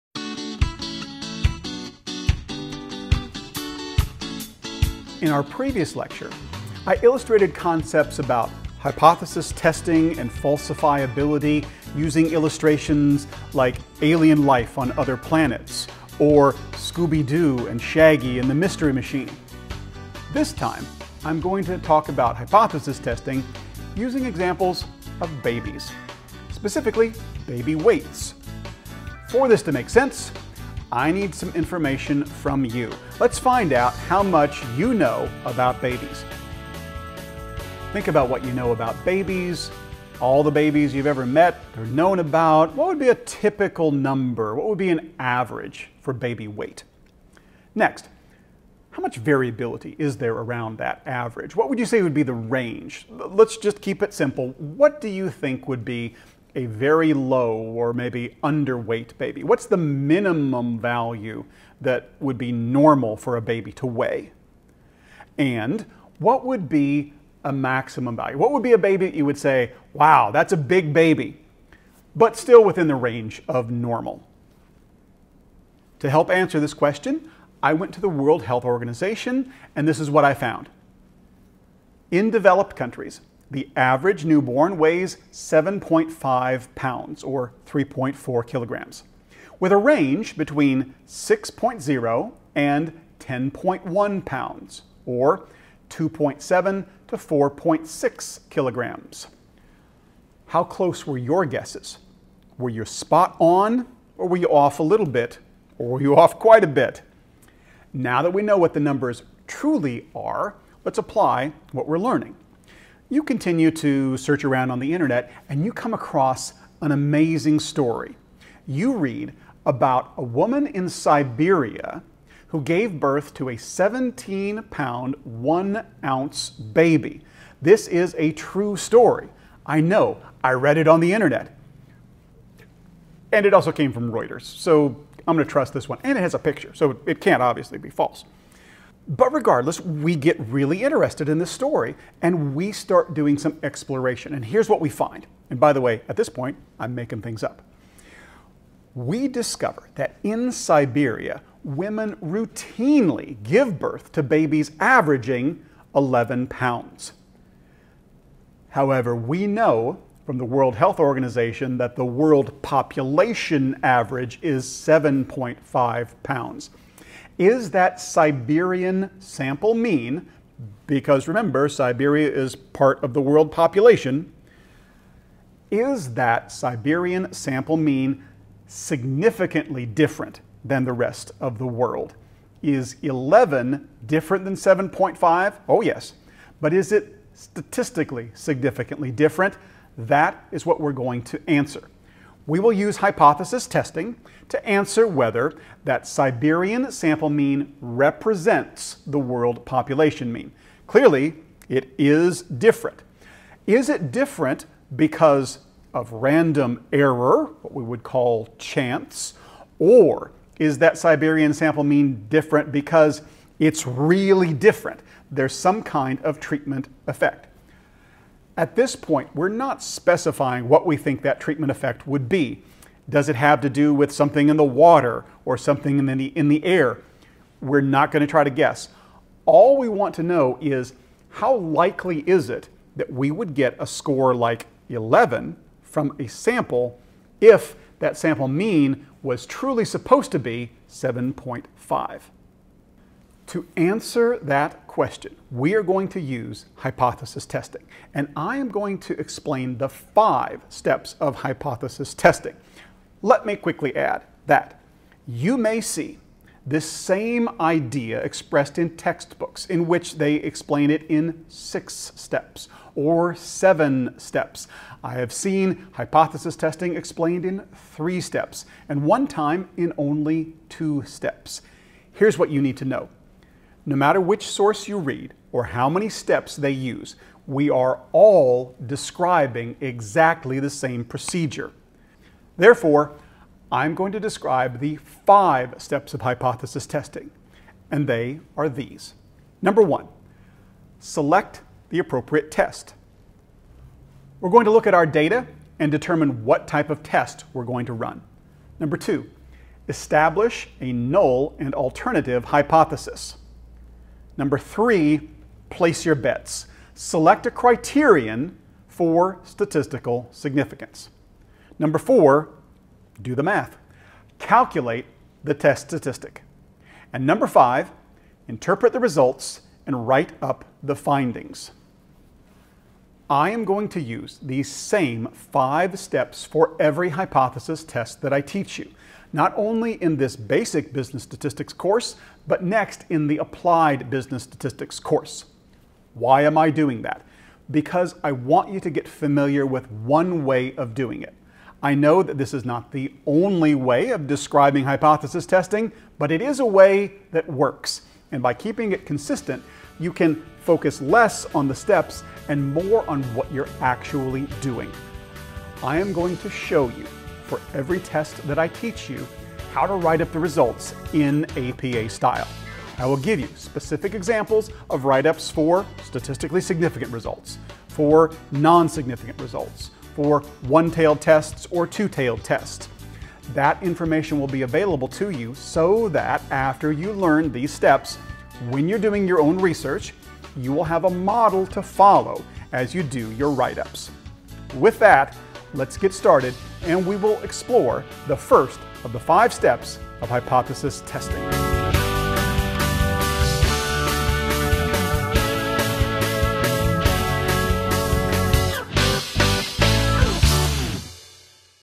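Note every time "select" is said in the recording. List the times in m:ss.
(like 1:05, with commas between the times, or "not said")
4:50, 5:06.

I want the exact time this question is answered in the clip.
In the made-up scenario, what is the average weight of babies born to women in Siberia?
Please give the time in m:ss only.
2:35.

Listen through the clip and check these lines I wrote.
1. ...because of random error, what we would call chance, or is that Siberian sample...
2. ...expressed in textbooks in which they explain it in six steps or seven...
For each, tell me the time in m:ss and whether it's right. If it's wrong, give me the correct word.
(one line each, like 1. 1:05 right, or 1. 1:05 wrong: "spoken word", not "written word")
1. 3:24 right
2. 4:18 right.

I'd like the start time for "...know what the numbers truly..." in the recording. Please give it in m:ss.
1:48.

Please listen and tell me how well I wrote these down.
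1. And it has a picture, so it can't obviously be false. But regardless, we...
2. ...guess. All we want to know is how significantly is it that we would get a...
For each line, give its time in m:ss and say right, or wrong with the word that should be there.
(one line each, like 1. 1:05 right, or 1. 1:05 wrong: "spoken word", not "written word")
1. 2:16 right
2. 3:48 wrong: "likely", not "significantly".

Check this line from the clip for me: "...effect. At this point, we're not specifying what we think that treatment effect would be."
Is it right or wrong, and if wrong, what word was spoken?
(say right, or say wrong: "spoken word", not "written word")
right.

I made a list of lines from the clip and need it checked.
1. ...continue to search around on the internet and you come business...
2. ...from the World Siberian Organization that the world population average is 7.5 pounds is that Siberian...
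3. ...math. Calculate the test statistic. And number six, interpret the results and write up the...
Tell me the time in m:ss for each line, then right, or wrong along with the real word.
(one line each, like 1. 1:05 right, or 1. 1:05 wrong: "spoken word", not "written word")
1. 1:53 wrong: "across", not "business"
2. 2:40 wrong: "Health", not "Siberian"
3. 5:13 wrong: "five", not "six".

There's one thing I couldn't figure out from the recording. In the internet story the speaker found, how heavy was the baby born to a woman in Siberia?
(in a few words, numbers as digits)
17 pounds, 1 ounce.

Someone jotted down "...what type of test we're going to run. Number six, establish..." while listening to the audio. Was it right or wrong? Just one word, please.
wrong.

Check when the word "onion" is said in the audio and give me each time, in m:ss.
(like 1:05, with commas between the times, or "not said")
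not said.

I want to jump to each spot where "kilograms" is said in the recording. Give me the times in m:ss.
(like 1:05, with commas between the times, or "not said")
1:28, 1:38.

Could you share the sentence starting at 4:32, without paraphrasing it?
Here's what you need to know.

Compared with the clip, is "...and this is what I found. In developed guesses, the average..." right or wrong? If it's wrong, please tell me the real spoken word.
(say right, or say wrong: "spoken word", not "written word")
wrong: "countries", not "guesses".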